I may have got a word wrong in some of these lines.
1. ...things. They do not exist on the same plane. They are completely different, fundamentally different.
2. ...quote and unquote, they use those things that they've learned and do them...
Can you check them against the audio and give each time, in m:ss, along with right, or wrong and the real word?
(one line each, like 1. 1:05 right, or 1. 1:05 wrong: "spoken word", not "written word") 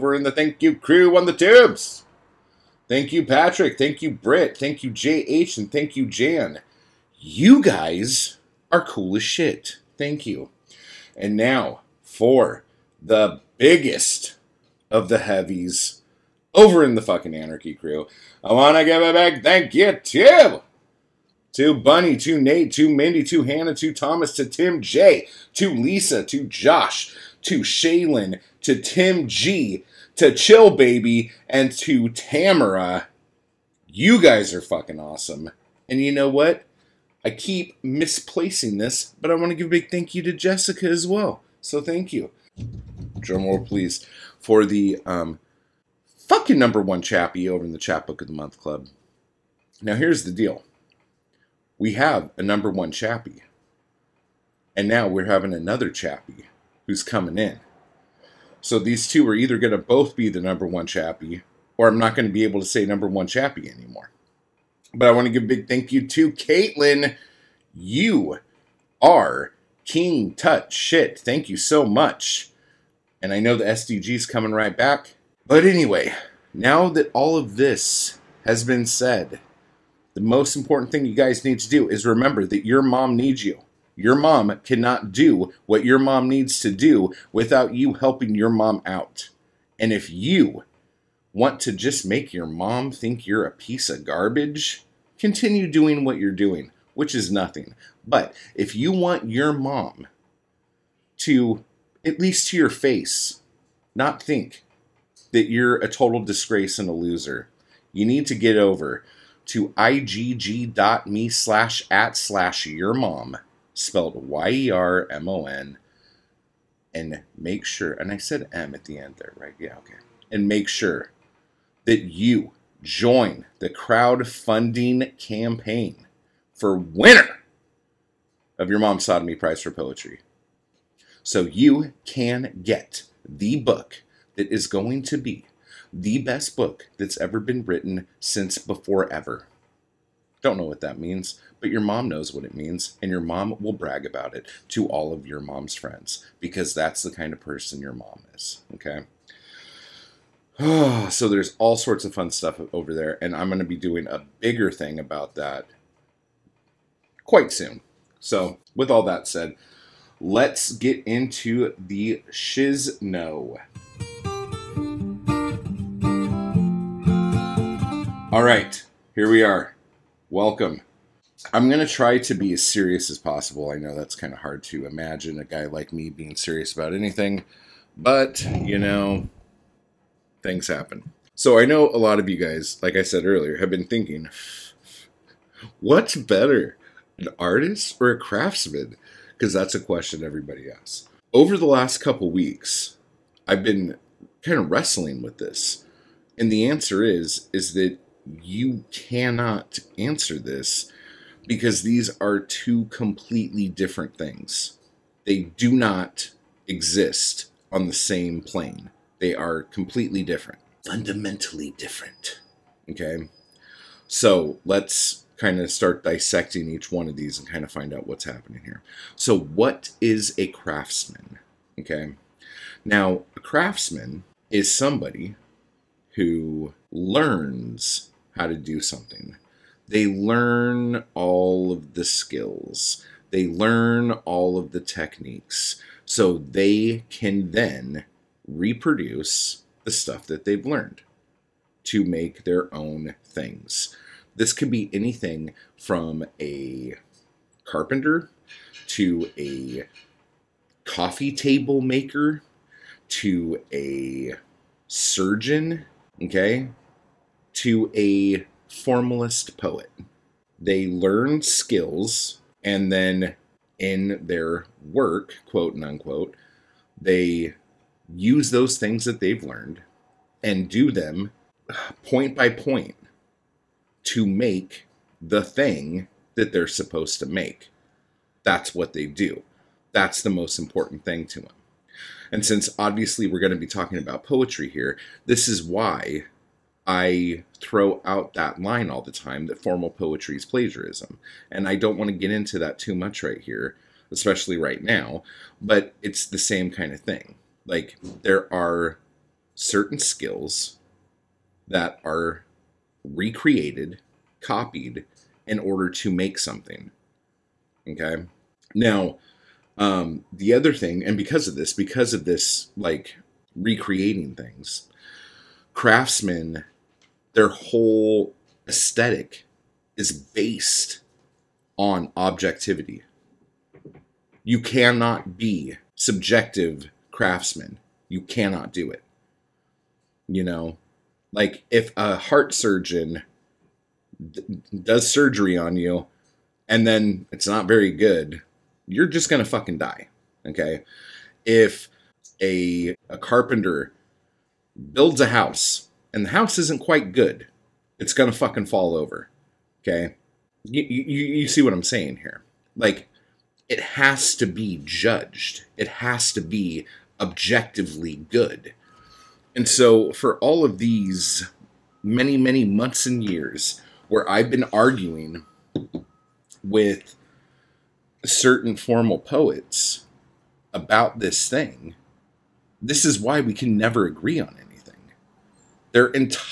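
1. 3:24 right
2. 4:25 right.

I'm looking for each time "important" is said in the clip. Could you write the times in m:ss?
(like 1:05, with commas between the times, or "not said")
1:20, 4:40.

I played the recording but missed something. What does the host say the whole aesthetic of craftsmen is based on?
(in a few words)
objectivity.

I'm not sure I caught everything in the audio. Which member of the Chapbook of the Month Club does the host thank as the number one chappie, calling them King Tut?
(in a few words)
Caitlin.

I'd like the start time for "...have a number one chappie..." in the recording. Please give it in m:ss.
0:51.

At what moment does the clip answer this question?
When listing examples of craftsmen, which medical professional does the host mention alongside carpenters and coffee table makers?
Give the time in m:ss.
4:13.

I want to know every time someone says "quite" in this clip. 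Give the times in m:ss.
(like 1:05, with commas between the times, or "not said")
2:37, 5:46.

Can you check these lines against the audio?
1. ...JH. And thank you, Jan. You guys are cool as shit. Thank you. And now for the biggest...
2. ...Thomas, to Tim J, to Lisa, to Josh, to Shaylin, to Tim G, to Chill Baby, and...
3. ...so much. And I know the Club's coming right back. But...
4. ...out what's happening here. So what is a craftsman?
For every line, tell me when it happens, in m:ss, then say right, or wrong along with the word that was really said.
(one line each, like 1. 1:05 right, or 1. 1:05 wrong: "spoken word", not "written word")
1. 0:04 right
2. 0:23 right
3. 1:11 wrong: "SDG", not "Club"
4. 3:37 right.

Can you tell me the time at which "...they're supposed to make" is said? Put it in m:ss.
4:36.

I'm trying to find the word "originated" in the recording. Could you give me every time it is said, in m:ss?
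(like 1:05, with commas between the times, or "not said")
not said.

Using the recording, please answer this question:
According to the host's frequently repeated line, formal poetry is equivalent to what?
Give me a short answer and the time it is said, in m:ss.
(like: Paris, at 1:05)
plagiarism, at 4:50.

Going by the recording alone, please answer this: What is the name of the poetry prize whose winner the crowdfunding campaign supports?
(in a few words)
Sawdoemee prize.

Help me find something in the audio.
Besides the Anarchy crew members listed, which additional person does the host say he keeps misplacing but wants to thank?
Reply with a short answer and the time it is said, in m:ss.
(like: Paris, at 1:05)
Jessica, at 0:40.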